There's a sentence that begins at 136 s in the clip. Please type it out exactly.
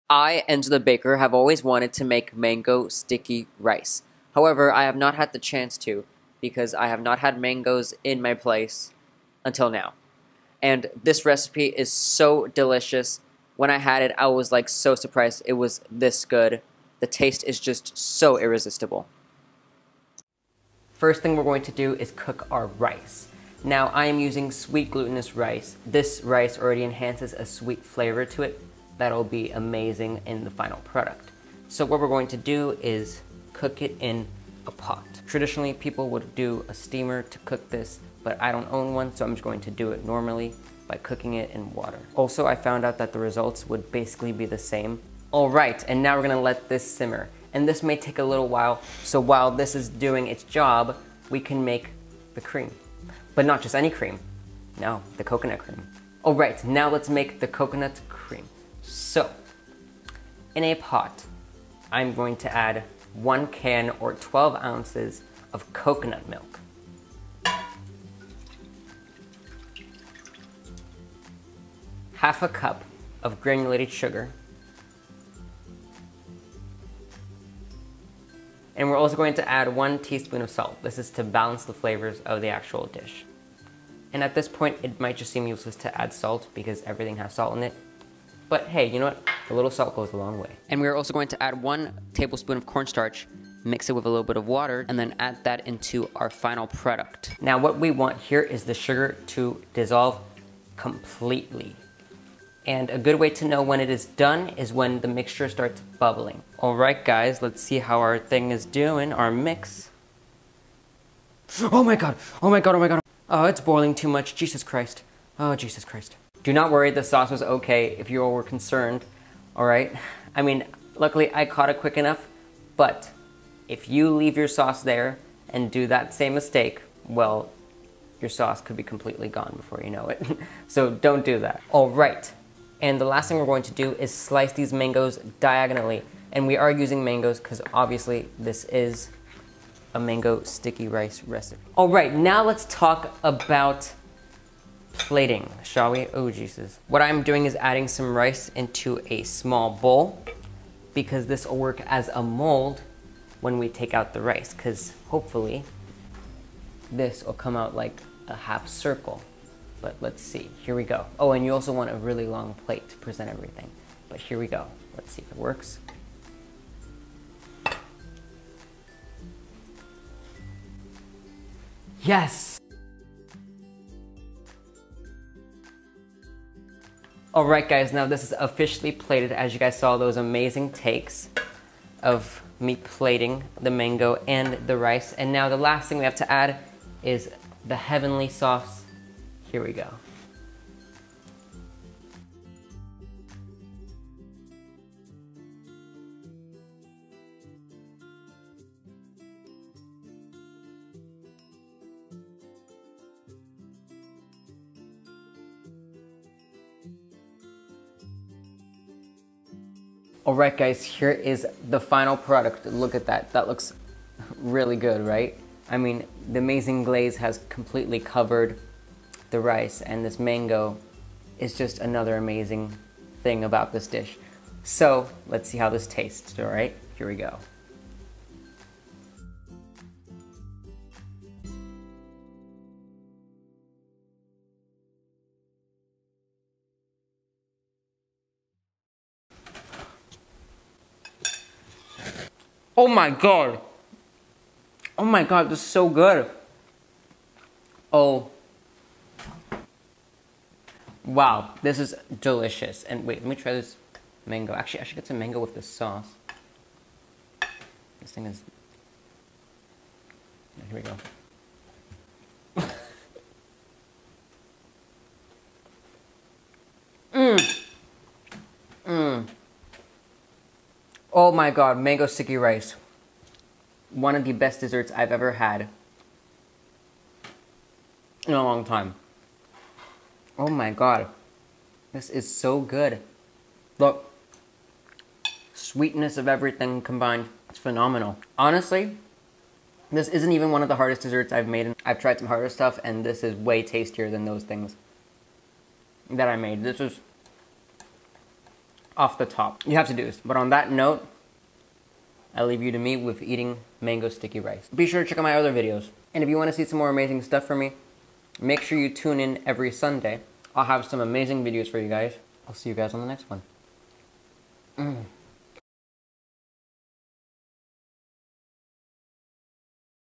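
And we are using mangoes because obviously this is a mango sticky rice recipe.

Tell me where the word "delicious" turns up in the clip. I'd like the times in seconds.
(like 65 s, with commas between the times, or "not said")
12 s, 252 s.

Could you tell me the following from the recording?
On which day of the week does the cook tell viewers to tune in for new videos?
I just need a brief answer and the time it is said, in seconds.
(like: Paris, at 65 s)
Sunday, at 309 s.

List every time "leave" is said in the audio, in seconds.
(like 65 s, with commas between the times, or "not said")
124 s, 302 s.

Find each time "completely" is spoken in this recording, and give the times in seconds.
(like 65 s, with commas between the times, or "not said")
100 s, 128 s, 217 s.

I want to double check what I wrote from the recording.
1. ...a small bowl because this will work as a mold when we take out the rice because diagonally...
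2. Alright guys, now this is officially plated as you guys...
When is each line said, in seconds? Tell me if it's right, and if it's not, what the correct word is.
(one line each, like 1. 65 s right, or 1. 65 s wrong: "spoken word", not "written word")
1. 149 s wrong: "hopefully", not "diagonally"
2. 177 s right.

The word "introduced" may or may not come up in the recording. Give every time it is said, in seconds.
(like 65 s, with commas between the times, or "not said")
not said.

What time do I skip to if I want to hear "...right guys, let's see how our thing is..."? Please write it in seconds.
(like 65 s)
106 s.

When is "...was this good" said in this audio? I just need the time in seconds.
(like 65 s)
15 s.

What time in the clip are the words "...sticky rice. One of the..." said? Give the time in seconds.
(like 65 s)
272 s.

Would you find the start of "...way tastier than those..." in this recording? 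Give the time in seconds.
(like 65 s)
293 s.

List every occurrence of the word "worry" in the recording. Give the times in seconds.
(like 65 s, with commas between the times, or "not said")
116 s.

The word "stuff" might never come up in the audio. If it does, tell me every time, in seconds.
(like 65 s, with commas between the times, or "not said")
292 s, 307 s.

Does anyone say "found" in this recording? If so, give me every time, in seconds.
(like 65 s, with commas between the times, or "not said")
42 s.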